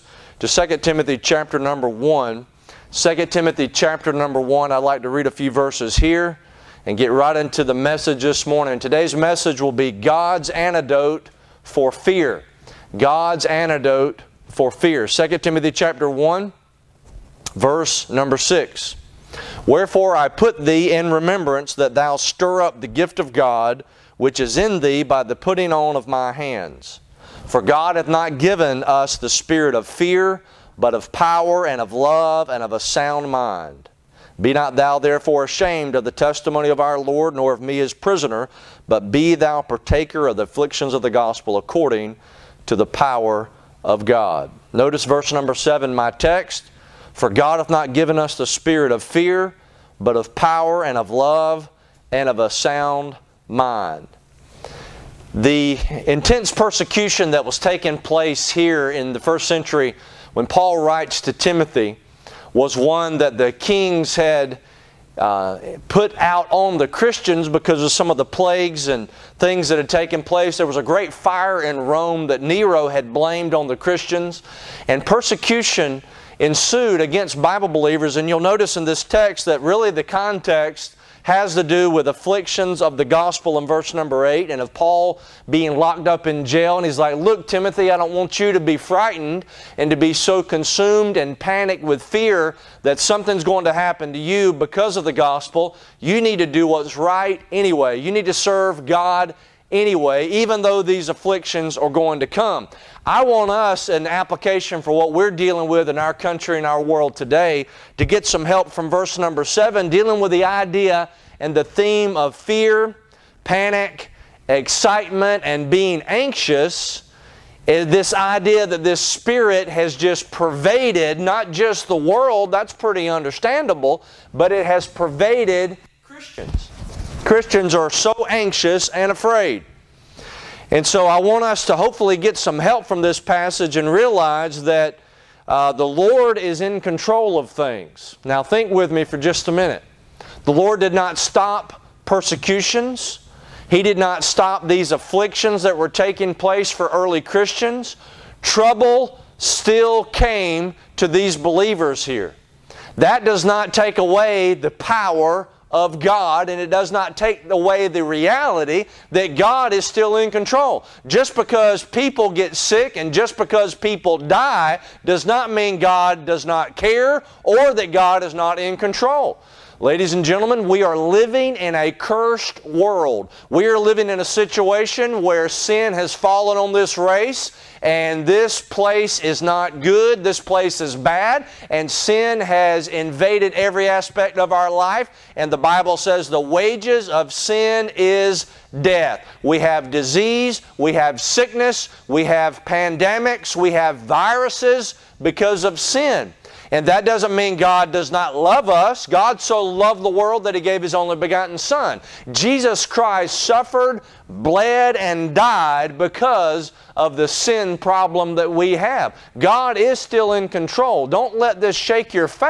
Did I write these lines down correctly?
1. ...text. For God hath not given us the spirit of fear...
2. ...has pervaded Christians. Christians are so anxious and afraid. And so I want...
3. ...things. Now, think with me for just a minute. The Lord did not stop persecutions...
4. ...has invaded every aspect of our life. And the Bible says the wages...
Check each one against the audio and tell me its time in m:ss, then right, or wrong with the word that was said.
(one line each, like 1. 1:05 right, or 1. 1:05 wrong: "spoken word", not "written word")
1. 0:46 right
2. 2:04 right
3. 2:17 right
4. 3:02 right.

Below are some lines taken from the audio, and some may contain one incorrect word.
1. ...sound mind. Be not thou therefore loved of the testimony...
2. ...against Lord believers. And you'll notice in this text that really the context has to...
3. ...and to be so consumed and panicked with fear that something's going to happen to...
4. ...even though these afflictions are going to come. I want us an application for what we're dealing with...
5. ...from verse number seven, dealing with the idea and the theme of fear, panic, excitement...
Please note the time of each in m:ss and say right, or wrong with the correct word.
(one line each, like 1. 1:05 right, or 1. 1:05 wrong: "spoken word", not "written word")
1. 0:32 wrong: "ashamed", not "loved"
2. 1:17 wrong: "Bible", not "Lord"
3. 1:29 right
4. 1:40 right
5. 1:48 right.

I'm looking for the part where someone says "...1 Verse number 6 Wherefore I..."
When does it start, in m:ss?
0:16.